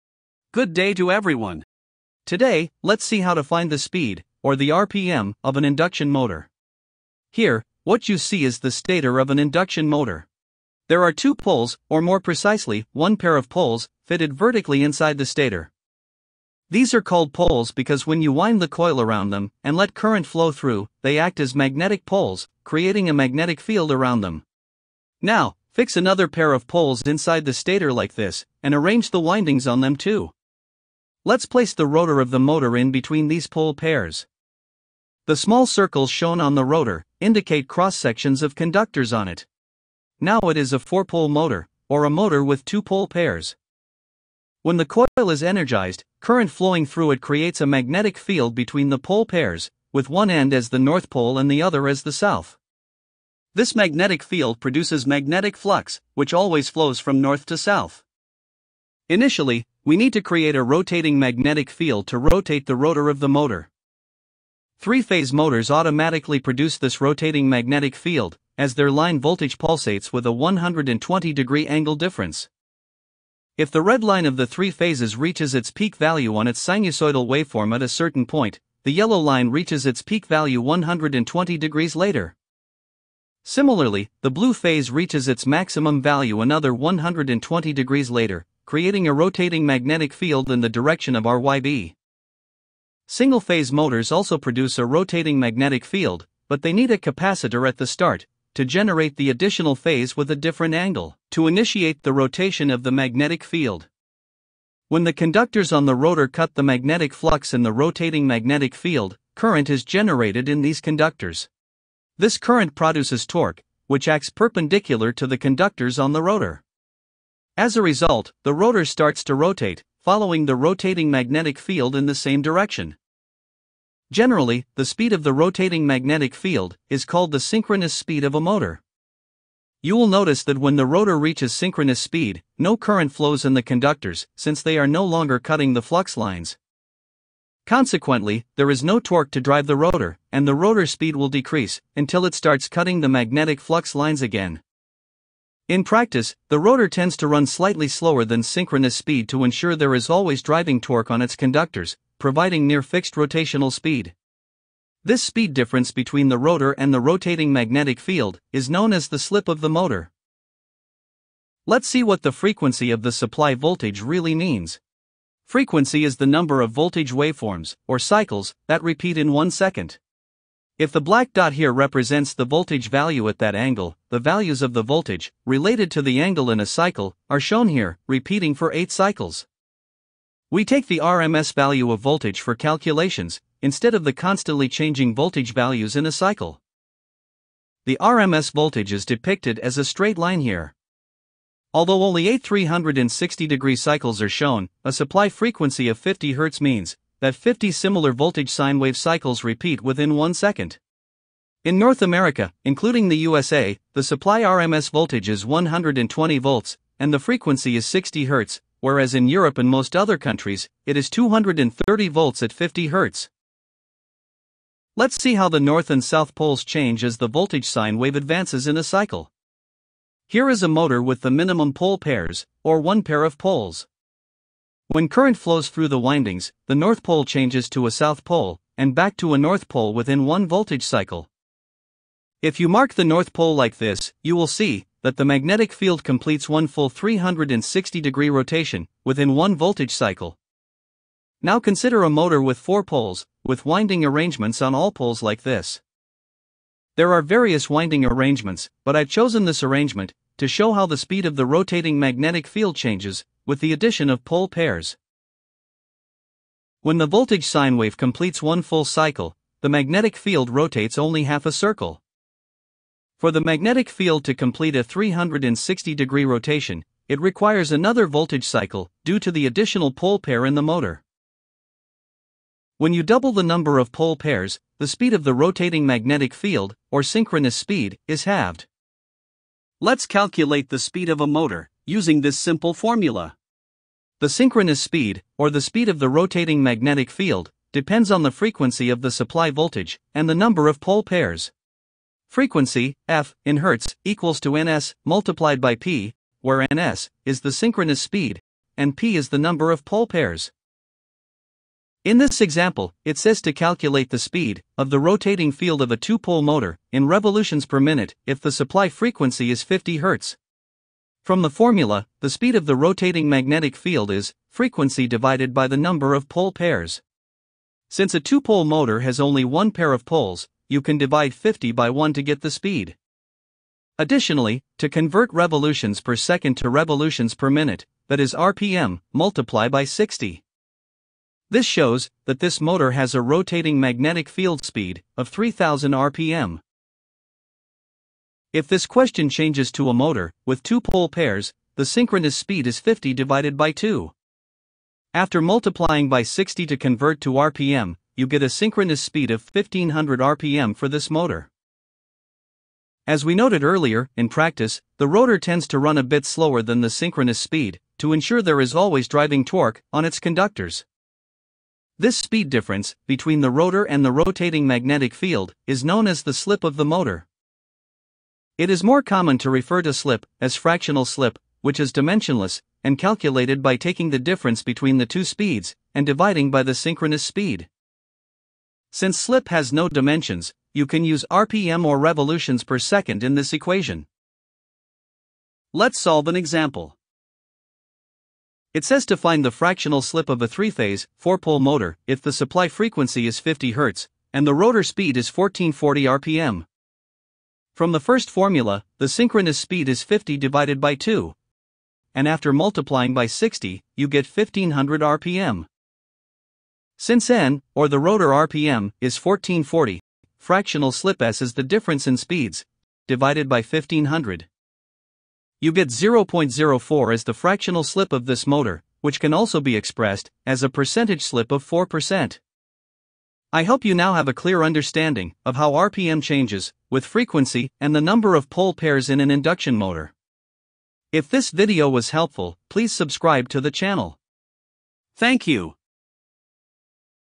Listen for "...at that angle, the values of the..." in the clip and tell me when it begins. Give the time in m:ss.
2:53.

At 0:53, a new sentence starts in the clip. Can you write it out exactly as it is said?
This magnetic field produces magnetic flux, which always flows from north to south.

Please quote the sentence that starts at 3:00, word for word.
We take the RMS value of voltage for calculations, instead of the constantly changing voltage values in a cycle.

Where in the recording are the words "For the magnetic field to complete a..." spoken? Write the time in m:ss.
4:23.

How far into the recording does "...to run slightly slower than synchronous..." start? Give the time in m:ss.
2:27.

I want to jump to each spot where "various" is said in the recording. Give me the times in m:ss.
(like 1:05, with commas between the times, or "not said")
4:07.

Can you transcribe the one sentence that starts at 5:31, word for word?
This shows that this motor has a rotating magnetic field speed of 3000 RPM.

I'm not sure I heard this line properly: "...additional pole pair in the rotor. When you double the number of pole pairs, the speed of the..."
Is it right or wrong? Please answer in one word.
wrong.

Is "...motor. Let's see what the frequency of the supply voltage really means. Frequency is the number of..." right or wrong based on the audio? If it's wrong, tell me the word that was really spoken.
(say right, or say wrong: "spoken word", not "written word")
right.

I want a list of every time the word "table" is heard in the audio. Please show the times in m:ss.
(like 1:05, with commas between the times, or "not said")
not said.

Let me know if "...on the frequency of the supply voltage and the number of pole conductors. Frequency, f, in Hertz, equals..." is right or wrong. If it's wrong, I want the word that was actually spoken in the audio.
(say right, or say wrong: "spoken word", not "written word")
wrong: "pairs", not "conductors".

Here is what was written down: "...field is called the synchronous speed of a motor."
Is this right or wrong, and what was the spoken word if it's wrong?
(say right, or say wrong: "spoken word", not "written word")
right.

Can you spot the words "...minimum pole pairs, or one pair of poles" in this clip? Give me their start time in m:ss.
3:41.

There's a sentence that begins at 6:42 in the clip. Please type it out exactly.
And after multiplying by 60, you get 1500 RPM.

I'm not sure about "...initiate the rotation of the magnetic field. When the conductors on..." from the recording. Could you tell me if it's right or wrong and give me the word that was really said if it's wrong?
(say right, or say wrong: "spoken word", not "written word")
right.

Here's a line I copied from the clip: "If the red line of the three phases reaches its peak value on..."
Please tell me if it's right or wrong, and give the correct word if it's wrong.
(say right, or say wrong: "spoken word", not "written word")
right.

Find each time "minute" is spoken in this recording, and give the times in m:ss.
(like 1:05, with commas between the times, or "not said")
5:07, 5:27.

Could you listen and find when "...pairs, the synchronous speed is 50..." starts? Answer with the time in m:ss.
5:41.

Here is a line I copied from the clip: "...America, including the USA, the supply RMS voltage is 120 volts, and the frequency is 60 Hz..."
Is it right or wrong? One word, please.
right.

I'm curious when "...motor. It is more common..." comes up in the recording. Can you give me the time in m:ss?
6:06.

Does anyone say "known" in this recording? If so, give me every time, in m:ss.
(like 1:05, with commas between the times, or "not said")
2:38, 6:05.